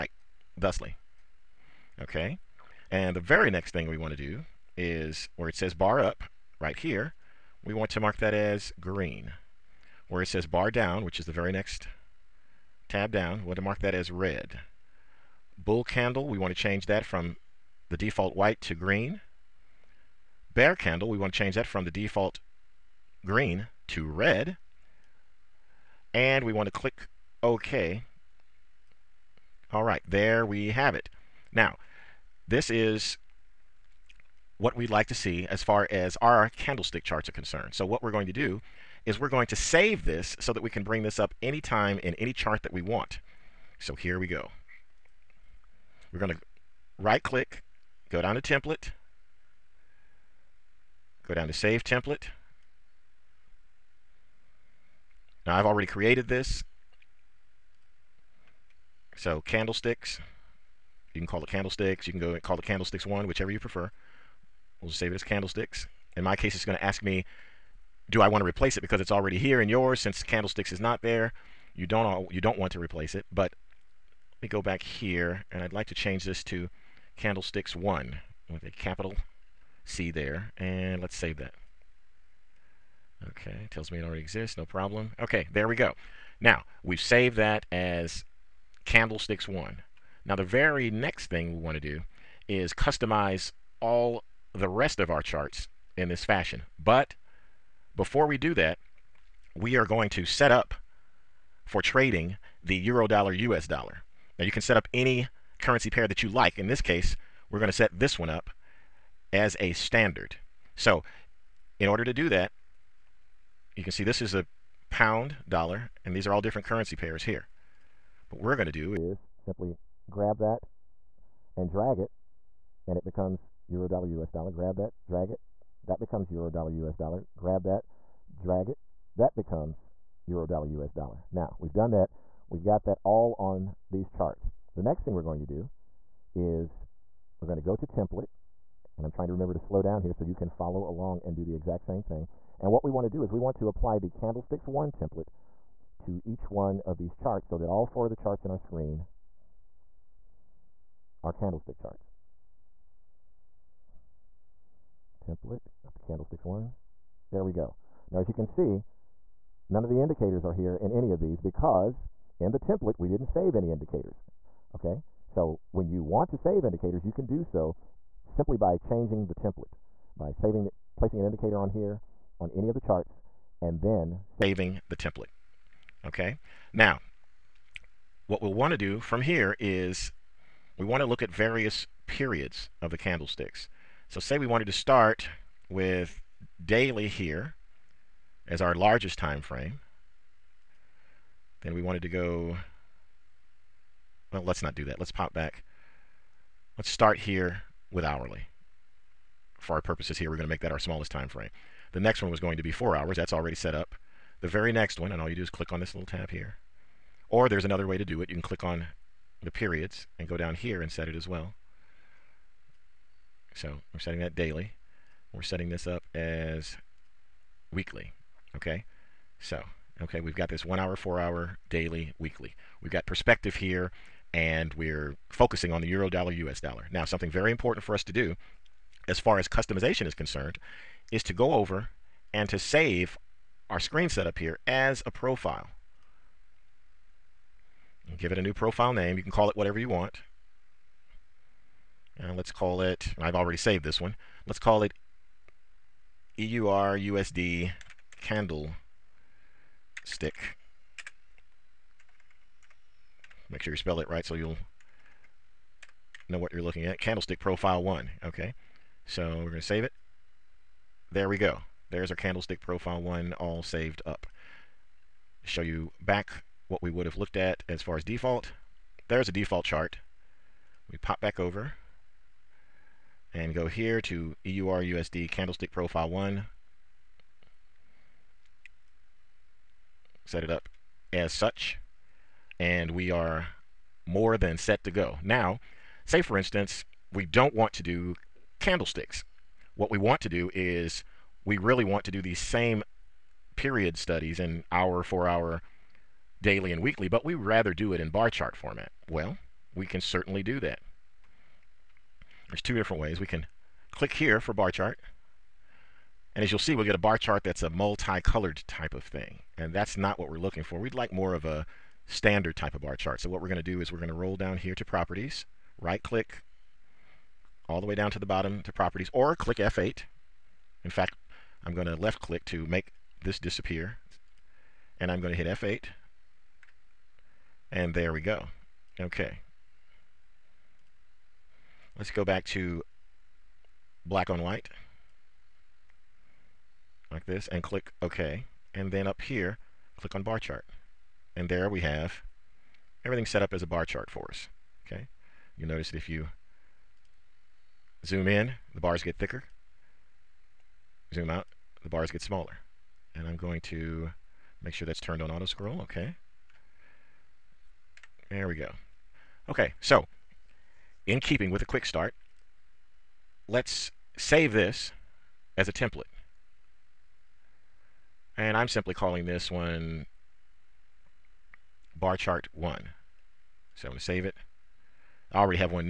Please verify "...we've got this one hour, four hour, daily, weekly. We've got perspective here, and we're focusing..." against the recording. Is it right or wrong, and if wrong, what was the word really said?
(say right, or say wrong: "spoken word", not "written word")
right.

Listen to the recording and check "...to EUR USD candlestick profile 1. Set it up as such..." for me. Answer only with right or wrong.
right.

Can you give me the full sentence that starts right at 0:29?
All right, there we have it.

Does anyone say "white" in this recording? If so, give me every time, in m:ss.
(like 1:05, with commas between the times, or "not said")
0:18, 5:34.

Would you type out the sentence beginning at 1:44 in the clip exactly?
Now you can set up any currency pair that you like.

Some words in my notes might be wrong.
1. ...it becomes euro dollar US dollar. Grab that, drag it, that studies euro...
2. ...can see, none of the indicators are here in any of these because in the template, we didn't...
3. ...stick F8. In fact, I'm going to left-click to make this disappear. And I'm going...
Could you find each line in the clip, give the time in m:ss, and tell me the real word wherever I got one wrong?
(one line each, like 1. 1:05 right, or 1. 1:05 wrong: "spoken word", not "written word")
1. 2:02 wrong: "becomes", not "studies"
2. 2:38 right
3. 5:19 wrong: "click", not "stick".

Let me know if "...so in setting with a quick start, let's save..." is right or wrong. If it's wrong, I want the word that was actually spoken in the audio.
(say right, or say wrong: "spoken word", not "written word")
wrong: "keeping", not "setting".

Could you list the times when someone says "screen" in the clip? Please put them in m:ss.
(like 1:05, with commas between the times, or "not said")
2:28, 3:53.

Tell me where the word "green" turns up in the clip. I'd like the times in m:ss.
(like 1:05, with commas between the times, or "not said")
0:08, 0:18, 0:23.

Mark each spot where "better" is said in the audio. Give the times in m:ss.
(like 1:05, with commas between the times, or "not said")
not said.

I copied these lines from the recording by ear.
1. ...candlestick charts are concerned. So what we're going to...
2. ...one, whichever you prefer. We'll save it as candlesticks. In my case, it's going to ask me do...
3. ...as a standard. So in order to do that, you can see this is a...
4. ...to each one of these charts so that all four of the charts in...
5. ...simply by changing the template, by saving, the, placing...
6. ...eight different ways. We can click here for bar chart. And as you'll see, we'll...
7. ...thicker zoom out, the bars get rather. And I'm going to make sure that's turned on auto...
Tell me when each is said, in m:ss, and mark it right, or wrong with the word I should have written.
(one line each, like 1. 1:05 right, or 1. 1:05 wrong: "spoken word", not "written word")
1. 0:36 right
2. 1:03 right
3. 1:49 right
4. 2:25 right
5. 2:48 right
6. 5:02 wrong: "two", not "eight"
7. 5:49 wrong: "smaller", not "rather".